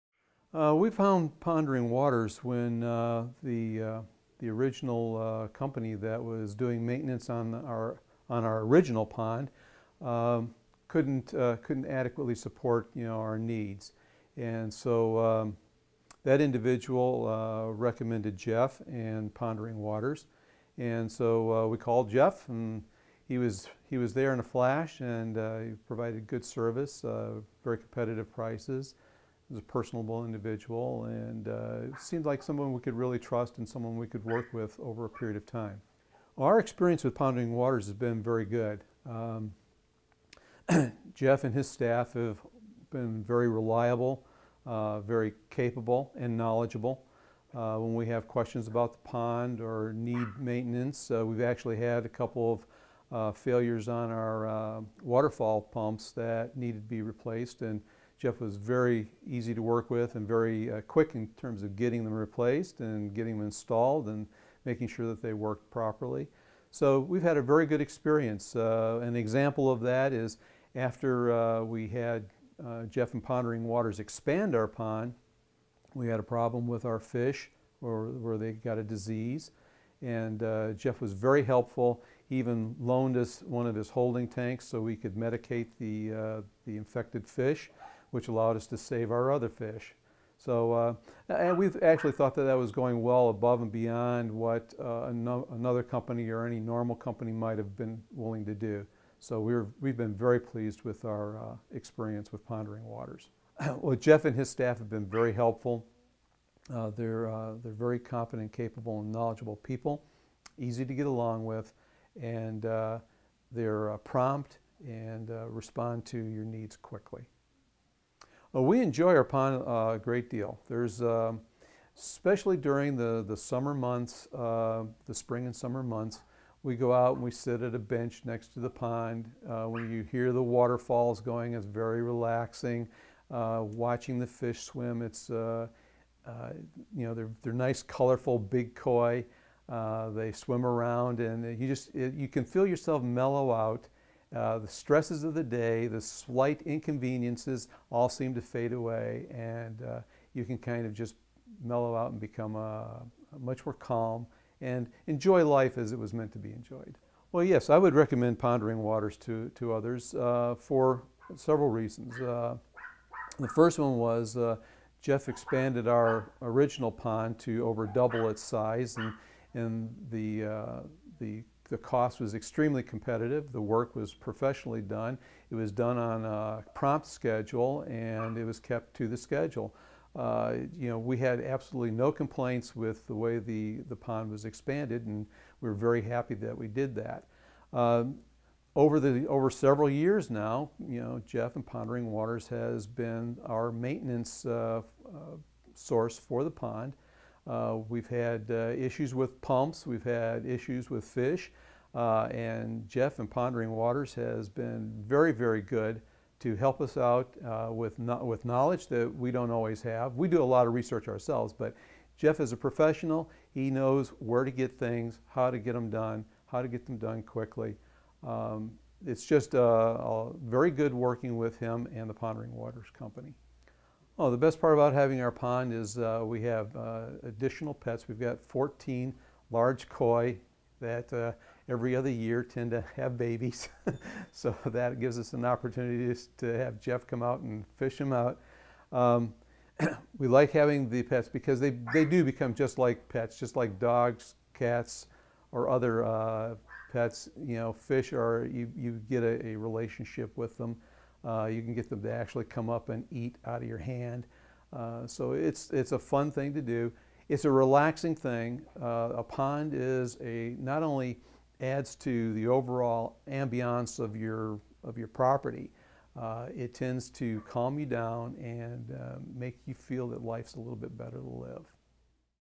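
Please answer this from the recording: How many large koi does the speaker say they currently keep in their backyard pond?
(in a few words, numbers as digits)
14.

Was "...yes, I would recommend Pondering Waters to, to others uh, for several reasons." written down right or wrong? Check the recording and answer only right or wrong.
right.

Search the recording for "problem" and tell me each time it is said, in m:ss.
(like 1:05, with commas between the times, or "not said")
1:16.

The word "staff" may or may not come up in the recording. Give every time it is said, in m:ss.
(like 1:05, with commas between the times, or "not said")
0:41, 1:44.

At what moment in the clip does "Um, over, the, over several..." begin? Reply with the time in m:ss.
3:07.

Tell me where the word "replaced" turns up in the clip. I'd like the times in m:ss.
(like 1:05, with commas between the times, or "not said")
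0:57, 1:02.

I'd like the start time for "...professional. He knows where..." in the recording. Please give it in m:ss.
3:32.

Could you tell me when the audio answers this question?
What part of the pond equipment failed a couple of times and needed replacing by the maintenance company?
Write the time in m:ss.
0:55.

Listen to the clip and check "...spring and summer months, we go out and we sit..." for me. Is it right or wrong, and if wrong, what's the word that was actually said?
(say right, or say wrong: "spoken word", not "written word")
right.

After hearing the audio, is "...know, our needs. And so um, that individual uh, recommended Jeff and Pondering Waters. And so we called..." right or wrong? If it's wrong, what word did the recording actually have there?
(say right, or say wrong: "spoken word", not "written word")
right.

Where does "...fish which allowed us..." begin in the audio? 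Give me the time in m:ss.
1:27.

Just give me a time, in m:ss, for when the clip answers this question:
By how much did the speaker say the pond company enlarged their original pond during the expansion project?
2:47.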